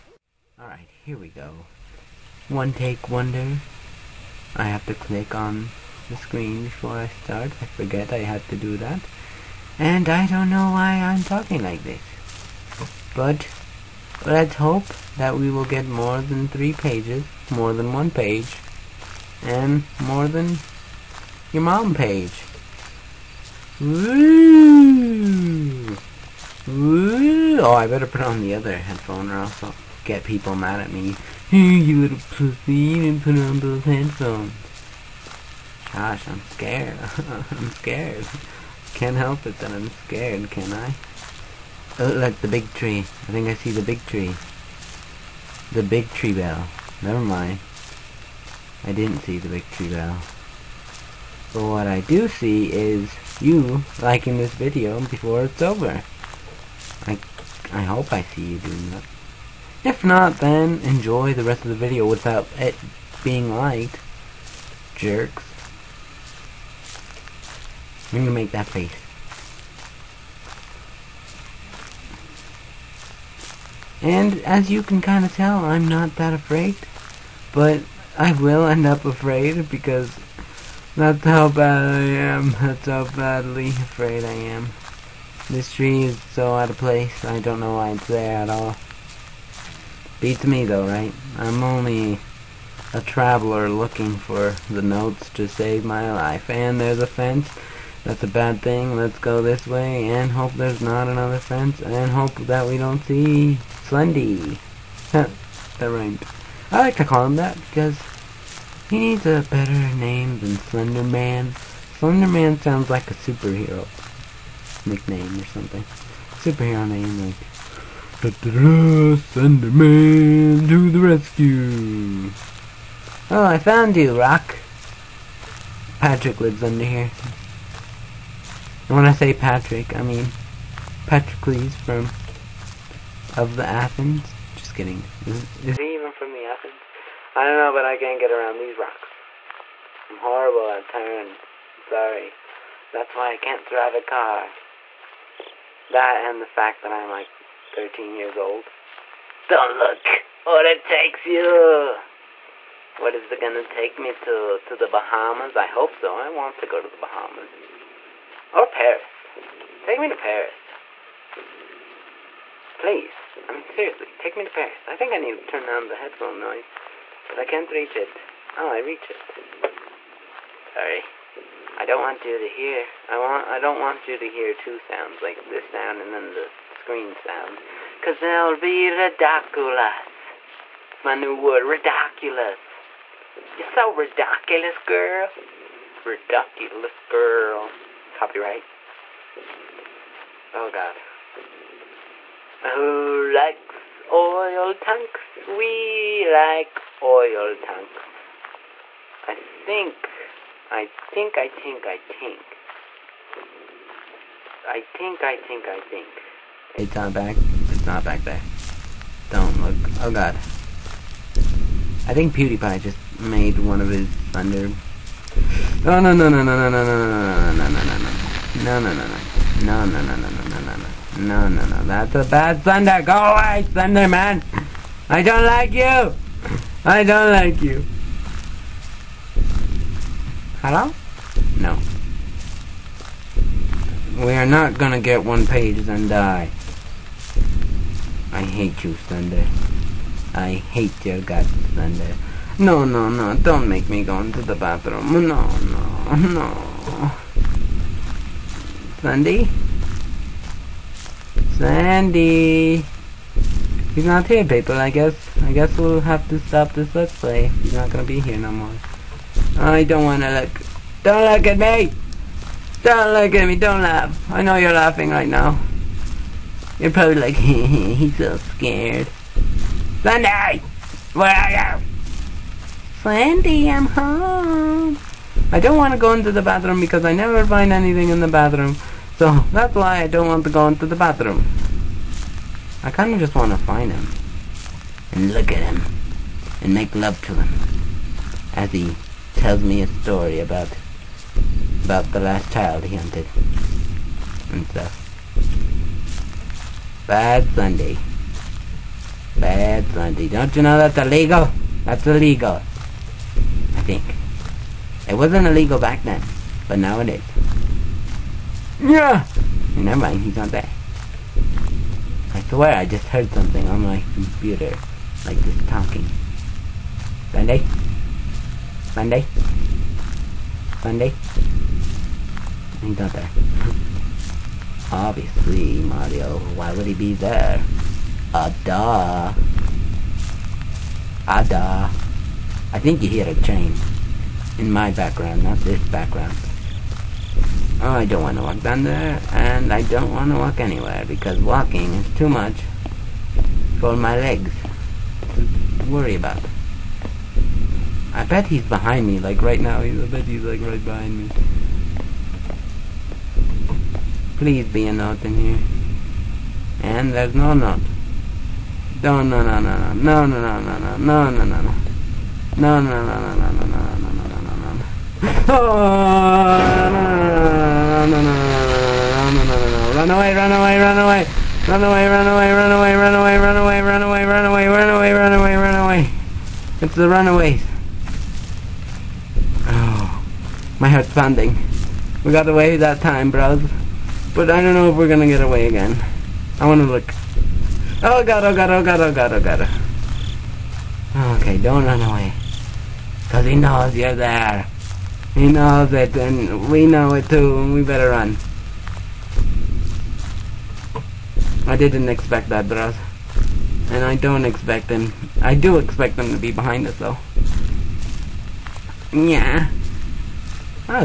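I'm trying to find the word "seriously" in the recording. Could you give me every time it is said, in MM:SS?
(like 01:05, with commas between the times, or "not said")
02:43.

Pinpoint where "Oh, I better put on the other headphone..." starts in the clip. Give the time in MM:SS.
00:27.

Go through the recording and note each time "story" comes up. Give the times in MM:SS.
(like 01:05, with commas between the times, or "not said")
04:49.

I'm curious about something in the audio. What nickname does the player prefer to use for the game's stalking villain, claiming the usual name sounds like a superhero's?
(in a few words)
Slendy.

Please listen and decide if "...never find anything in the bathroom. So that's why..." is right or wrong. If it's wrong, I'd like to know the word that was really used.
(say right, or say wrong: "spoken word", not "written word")
right.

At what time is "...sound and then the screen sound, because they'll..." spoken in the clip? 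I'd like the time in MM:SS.
02:55.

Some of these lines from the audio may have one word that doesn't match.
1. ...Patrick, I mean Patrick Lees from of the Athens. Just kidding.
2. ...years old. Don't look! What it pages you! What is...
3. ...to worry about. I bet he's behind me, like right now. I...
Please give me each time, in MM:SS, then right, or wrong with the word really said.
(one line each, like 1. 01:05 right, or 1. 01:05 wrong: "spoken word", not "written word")
1. 02:09 right
2. 02:28 wrong: "takes", not "pages"
3. 05:45 right.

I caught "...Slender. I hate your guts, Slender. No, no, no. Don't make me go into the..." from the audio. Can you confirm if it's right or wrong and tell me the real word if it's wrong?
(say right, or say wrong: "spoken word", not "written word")
right.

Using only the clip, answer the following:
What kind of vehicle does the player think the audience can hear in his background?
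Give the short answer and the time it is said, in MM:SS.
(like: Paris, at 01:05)
train, at 05:33.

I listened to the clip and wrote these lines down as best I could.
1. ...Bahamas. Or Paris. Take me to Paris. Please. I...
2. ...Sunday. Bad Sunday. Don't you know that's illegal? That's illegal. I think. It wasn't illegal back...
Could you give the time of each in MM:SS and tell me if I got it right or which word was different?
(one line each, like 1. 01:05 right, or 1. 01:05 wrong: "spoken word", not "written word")
1. 02:36 right
2. 04:57 right.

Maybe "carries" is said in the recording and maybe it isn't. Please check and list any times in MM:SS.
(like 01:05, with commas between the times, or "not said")
not said.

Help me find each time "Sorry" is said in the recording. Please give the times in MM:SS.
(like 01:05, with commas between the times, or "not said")
02:21, 02:50.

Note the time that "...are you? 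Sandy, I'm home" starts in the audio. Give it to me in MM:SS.
04:31.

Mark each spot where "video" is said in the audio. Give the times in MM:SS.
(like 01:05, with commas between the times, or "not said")
00:54, 01:01.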